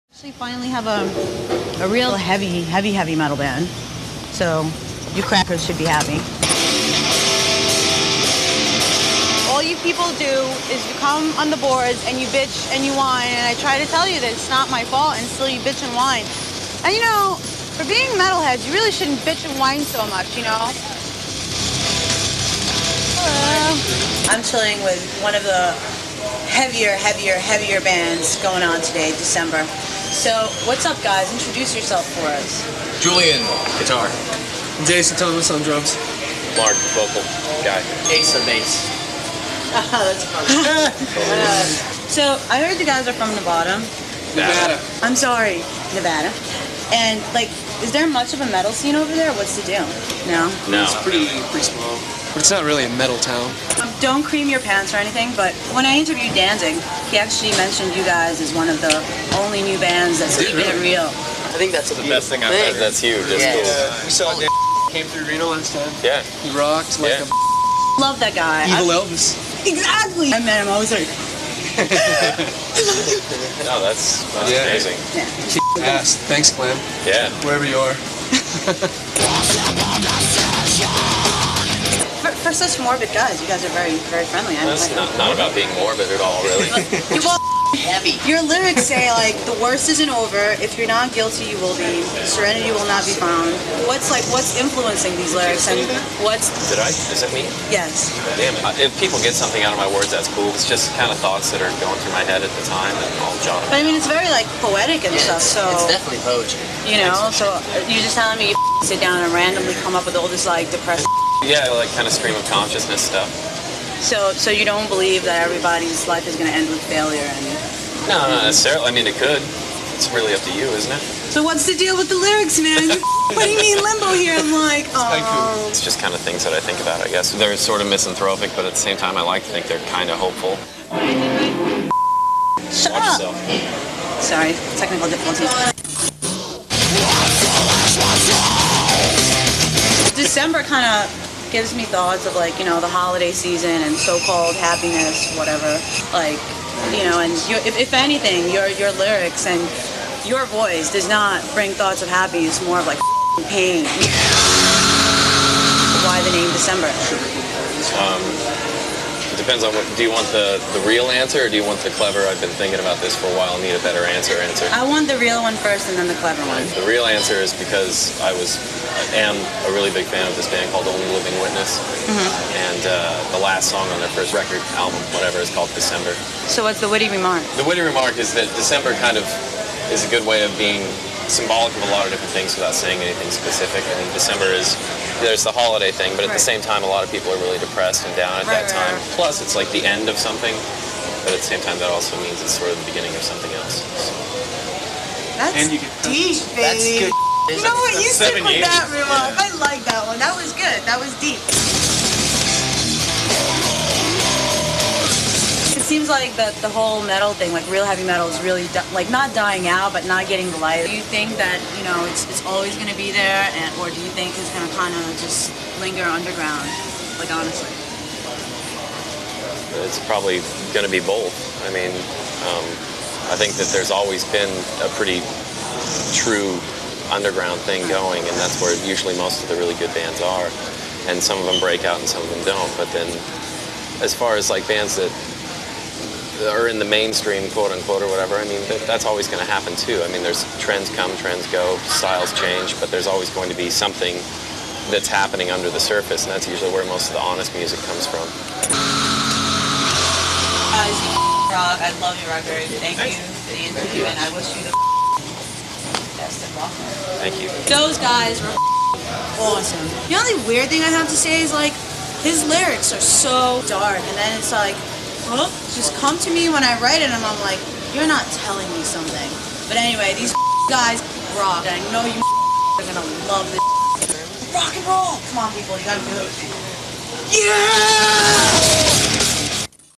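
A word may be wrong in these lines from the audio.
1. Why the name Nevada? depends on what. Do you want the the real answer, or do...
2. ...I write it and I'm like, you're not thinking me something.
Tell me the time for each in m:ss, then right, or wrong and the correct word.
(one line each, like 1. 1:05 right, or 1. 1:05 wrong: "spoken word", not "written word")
1. 2:36 wrong: "December", not "Nevada"
2. 4:26 wrong: "telling", not "thinking".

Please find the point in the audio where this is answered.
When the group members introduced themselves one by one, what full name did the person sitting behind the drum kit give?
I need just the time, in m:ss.
0:34.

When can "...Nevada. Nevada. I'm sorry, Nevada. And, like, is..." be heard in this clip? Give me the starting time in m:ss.
0:43.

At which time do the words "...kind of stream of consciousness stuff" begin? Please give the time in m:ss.
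1:51.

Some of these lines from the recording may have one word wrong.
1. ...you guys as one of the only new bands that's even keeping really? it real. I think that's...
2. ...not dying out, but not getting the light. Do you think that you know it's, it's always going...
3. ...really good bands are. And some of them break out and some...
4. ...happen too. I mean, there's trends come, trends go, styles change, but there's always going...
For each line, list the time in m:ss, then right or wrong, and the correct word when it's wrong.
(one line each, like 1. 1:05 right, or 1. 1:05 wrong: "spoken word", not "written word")
1. 0:57 right
2. 3:29 right
3. 3:49 right
4. 3:59 right.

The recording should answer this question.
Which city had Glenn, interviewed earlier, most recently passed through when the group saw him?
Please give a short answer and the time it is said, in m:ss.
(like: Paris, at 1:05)
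Reno, at 1:05.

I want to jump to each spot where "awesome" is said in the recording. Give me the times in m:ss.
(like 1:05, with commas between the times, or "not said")
4:19.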